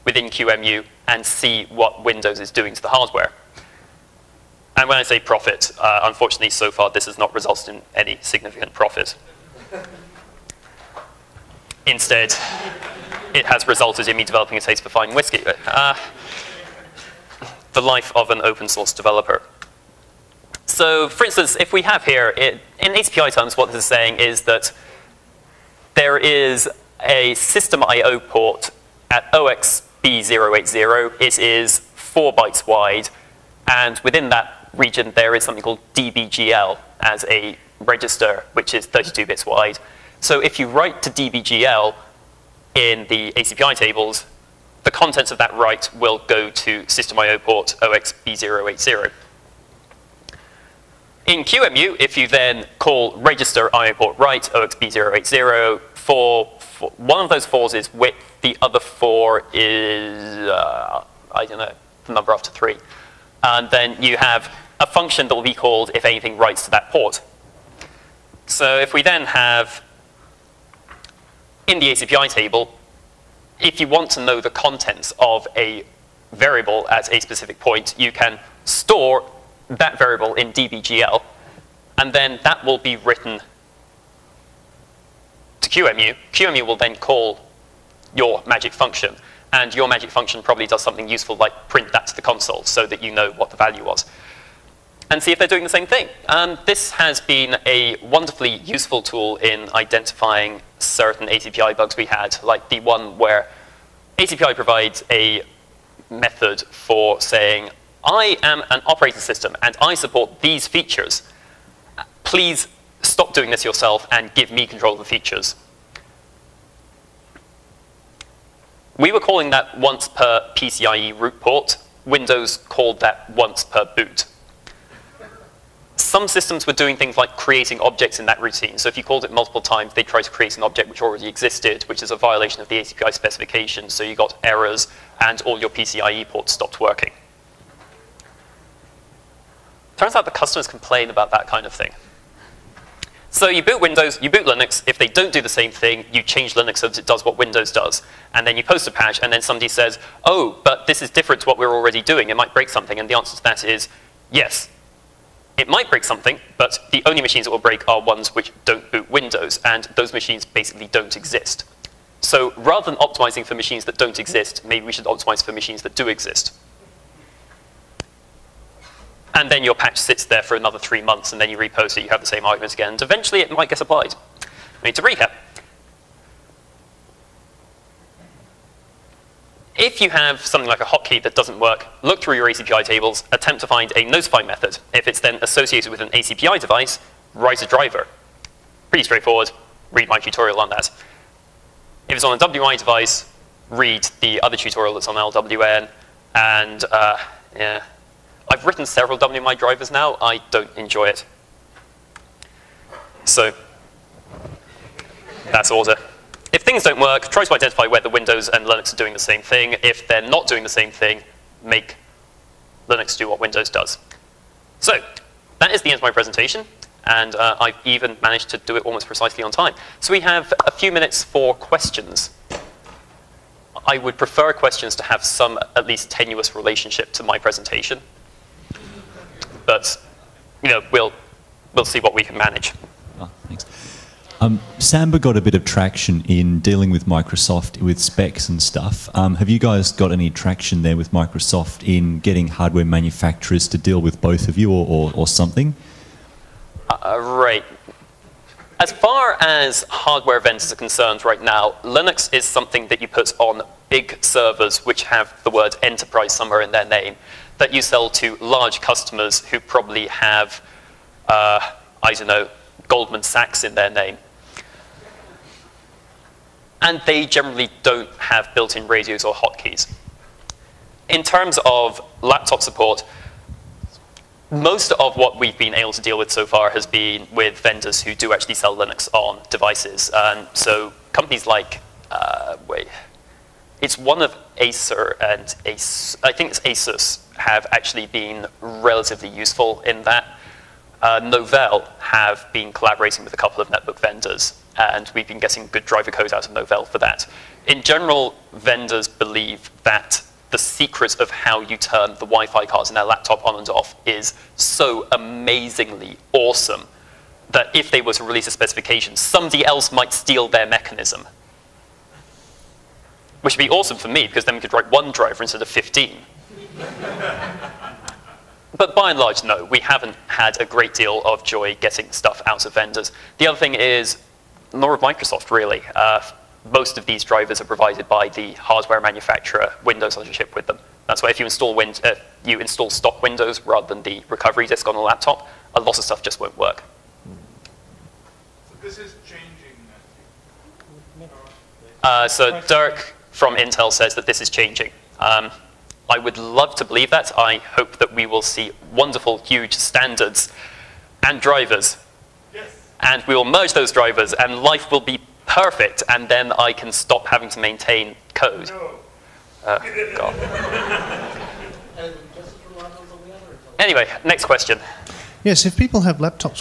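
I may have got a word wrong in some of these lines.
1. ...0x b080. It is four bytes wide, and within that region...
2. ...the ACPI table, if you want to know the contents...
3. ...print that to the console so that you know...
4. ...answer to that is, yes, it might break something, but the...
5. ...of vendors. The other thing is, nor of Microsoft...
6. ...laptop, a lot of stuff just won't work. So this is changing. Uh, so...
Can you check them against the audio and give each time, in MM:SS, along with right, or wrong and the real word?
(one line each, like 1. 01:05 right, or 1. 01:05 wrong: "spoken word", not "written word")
1. 00:29 right
2. 01:11 right
3. 01:31 right
4. 02:33 right
5. 05:22 right
6. 05:34 right.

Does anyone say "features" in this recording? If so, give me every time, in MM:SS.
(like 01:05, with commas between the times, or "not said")
01:50, 01:55.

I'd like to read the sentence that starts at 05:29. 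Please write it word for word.
Windows has a chip with them.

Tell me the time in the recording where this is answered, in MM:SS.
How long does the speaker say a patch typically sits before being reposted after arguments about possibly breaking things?
02:50.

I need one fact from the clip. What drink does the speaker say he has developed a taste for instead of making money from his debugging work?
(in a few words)
fine whiskey.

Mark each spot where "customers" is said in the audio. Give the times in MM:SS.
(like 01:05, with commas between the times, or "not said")
02:20, 04:18.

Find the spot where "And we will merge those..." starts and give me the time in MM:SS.
05:52.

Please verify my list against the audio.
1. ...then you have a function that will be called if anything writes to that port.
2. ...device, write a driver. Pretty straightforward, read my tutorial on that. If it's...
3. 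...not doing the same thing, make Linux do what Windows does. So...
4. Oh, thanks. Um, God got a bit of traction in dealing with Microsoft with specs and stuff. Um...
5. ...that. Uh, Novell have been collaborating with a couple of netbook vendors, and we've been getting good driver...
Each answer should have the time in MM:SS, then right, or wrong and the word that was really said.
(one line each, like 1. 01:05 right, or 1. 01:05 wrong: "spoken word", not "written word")
1. 01:03 right
2. 03:06 right
3. 03:30 right
4. 03:53 wrong: "Samba", not "God"
5. 04:50 right.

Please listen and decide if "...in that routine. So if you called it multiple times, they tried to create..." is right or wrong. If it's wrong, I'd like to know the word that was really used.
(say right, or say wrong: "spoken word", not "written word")
right.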